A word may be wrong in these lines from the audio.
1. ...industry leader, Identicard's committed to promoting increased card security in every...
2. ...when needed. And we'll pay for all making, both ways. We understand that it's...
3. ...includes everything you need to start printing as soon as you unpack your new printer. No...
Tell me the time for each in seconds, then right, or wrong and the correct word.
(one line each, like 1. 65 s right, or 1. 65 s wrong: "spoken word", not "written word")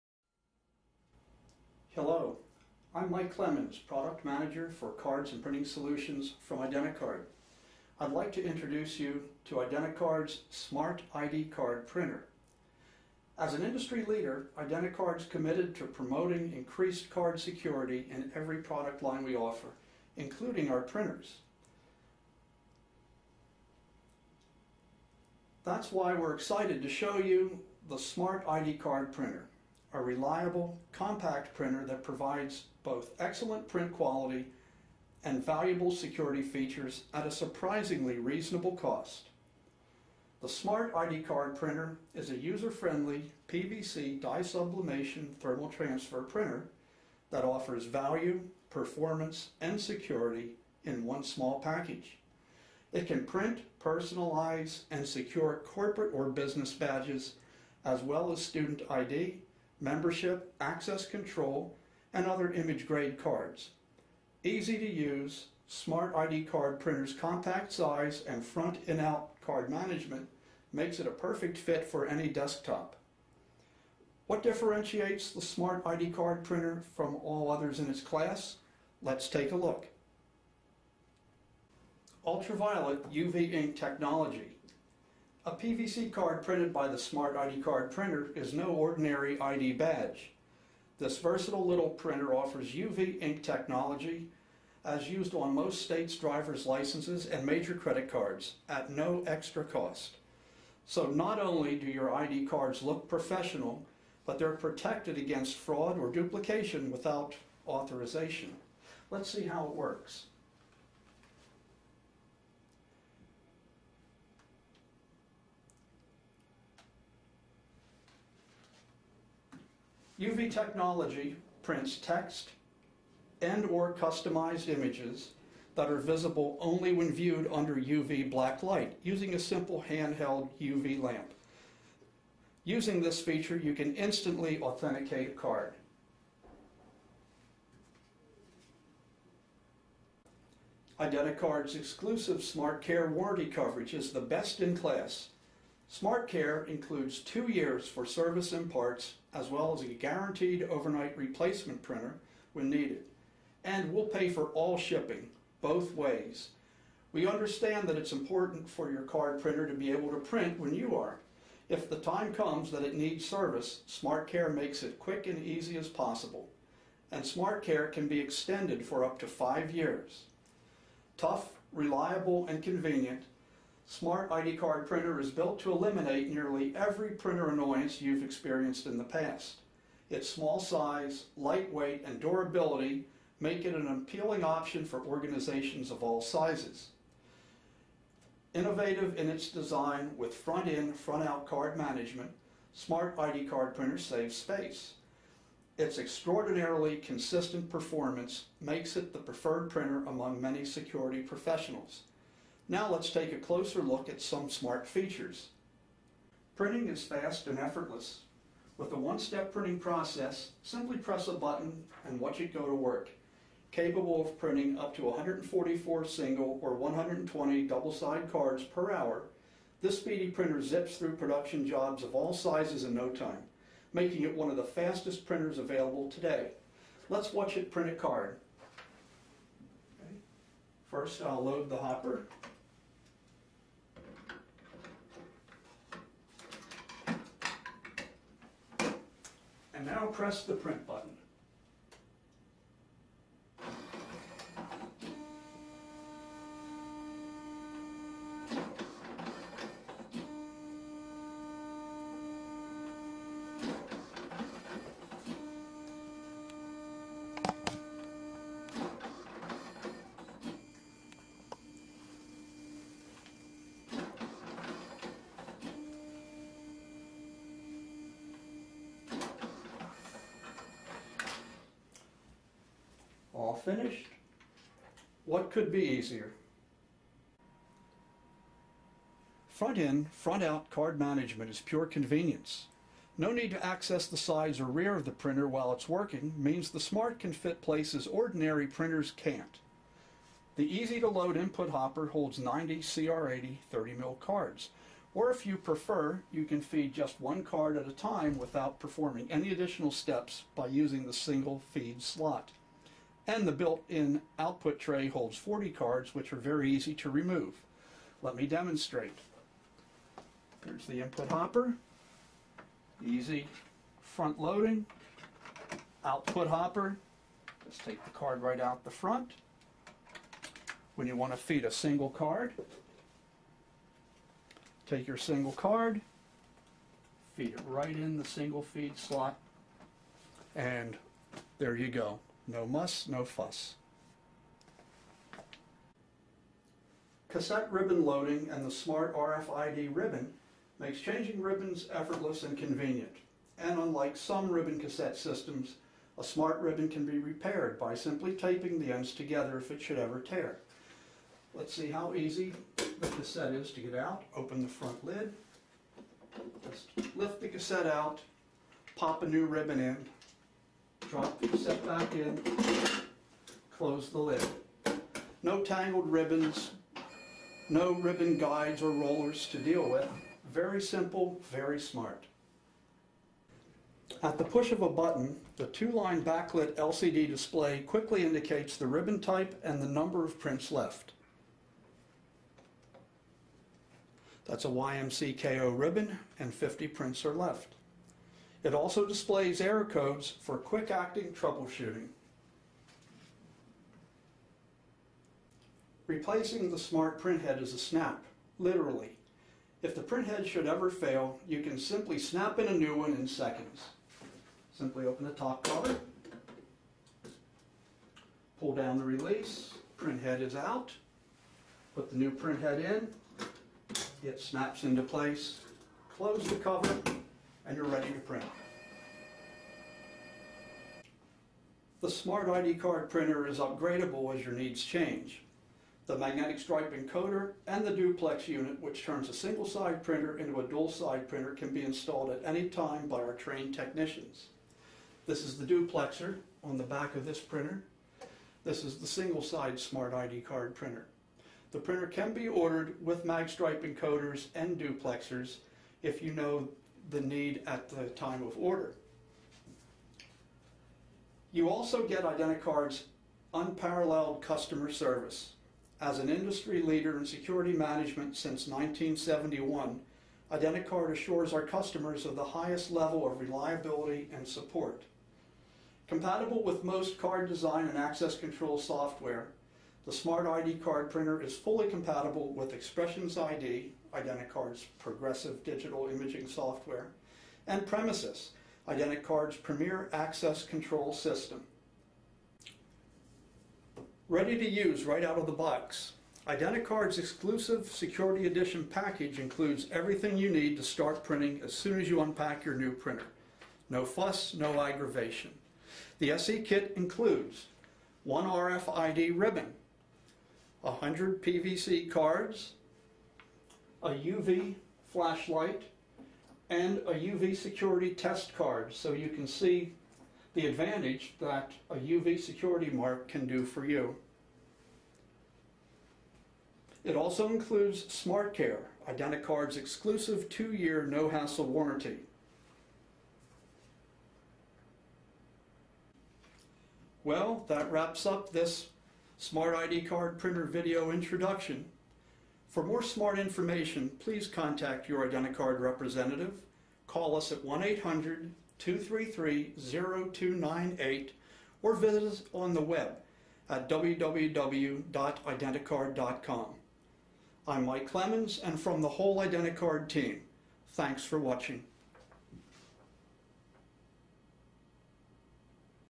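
1. 13 s right
2. 152 s wrong: "shipping", not "making"
3. 489 s right.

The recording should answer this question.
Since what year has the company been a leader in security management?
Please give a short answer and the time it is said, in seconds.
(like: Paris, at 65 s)
1971, at 458 s.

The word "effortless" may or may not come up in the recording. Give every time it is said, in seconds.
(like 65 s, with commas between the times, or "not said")
207 s, 341 s.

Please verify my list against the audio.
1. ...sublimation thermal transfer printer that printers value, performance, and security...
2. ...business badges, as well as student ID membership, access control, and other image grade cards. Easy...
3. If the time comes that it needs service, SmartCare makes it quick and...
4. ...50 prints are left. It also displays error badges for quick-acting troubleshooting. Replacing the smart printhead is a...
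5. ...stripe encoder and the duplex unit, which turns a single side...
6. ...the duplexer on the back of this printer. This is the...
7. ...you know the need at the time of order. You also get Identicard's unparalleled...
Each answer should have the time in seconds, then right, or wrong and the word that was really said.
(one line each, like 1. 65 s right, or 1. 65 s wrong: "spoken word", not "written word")
1. 44 s wrong: "offers", not "printers"
2. 56 s right
3. 161 s right
4. 386 s wrong: "codes", not "badges"
5. 426 s right
6. 435 s right
7. 446 s right.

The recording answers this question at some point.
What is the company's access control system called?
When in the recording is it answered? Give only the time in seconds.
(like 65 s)
477 s.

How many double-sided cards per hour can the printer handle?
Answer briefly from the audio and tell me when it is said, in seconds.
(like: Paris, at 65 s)
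120, at 216 s.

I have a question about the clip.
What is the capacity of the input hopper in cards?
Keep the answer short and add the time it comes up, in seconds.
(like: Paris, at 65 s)
90, at 292 s.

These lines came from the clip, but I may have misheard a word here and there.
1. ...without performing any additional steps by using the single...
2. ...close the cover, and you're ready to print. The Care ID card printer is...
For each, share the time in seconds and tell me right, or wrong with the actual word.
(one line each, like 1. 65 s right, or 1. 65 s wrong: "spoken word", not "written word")
1. 298 s right
2. 416 s wrong: "Smart", not "Care".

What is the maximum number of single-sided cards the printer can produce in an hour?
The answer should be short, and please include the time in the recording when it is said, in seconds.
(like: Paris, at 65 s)
144, at 215 s.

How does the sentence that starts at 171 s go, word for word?
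Tough, reliable, and convenient, Smart ID card printer is built to eliminate nearly every printer annoyance you've experienced in the past.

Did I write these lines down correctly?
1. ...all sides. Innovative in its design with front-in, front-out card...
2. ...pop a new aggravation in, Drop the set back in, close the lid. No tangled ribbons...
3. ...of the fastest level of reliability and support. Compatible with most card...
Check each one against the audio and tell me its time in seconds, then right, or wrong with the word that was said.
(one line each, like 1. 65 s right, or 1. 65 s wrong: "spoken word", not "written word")
1. 186 s wrong: "sizes", not "sides"
2. 358 s wrong: "ribbon", not "aggravation"
3. 462 s wrong: "highest", not "fastest".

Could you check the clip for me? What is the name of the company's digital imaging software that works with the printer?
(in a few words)
Expressions ID.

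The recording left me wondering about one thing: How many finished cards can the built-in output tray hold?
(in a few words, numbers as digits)
40.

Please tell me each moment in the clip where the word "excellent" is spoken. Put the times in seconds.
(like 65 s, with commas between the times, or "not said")
33 s.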